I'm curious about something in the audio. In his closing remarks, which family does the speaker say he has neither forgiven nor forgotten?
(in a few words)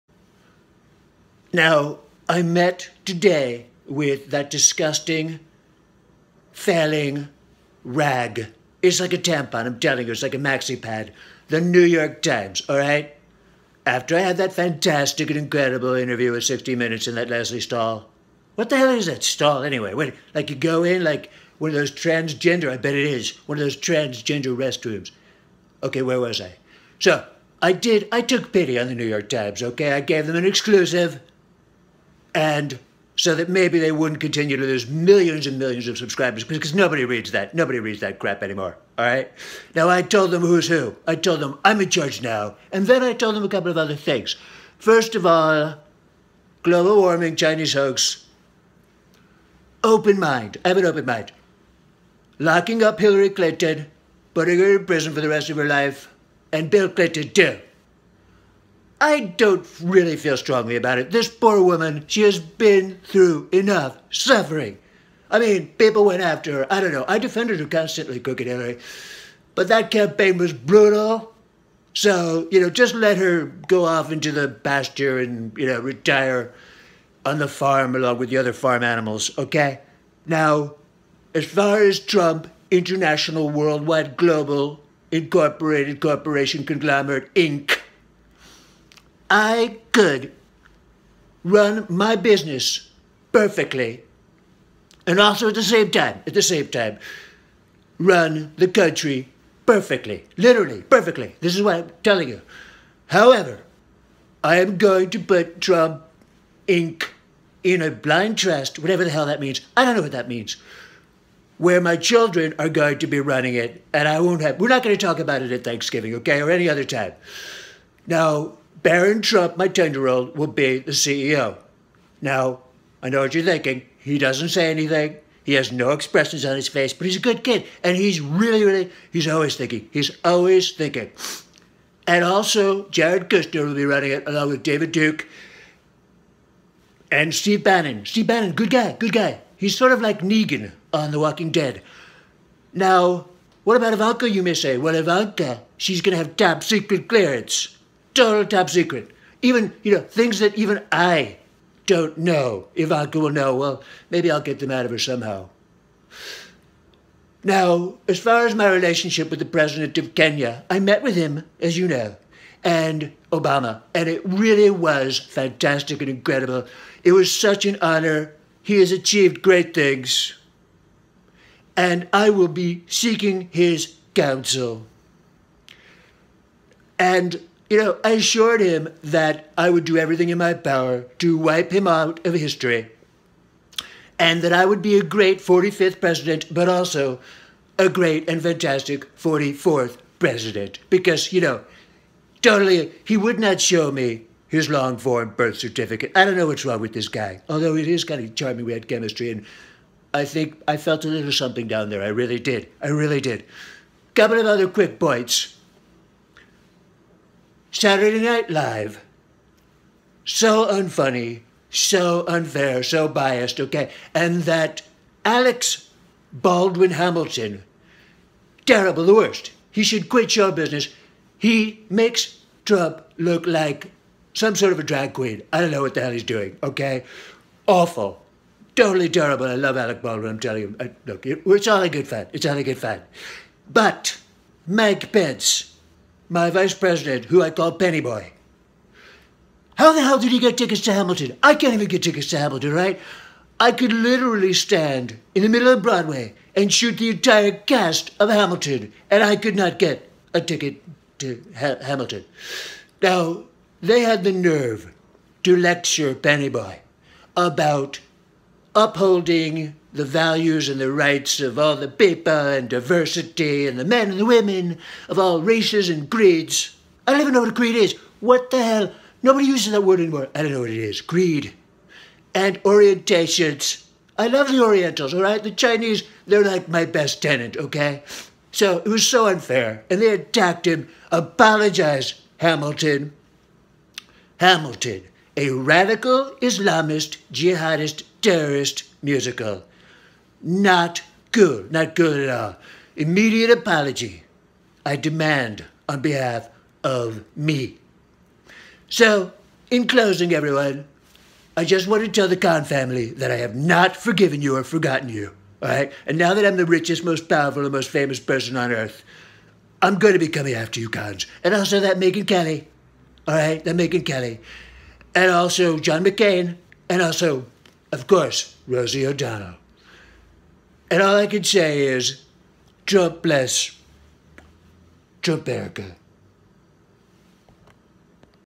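Khan family.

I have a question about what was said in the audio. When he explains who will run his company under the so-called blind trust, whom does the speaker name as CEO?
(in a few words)
Barron Trump.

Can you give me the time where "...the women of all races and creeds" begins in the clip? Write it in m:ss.
4:24.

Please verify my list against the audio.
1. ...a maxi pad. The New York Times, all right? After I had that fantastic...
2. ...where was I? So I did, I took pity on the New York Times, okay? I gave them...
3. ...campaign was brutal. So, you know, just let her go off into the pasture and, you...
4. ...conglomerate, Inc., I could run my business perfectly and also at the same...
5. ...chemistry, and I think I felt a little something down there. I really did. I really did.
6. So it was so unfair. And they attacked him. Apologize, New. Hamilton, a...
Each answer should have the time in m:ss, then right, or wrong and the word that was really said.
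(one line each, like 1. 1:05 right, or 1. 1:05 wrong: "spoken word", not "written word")
1. 0:10 right
2. 0:26 right
3. 1:09 right
4. 1:26 right
5. 3:18 right
6. 4:38 wrong: "Hamilton", not "New".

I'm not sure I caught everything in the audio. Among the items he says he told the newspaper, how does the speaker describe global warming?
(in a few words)
Chinese hoax.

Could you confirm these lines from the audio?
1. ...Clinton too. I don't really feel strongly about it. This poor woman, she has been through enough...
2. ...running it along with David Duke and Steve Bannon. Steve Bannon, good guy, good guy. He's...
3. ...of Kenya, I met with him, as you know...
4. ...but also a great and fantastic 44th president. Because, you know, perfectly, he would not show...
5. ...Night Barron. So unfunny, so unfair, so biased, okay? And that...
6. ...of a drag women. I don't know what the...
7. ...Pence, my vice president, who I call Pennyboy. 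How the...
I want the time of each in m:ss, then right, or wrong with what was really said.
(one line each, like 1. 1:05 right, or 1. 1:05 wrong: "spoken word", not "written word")
1. 0:56 right
2. 2:13 right
3. 2:39 right
4. 3:06 wrong: "totally", not "perfectly"
5. 3:28 wrong: "Live", not "Barron"
6. 3:44 wrong: "queen", not "women"
7. 3:55 right.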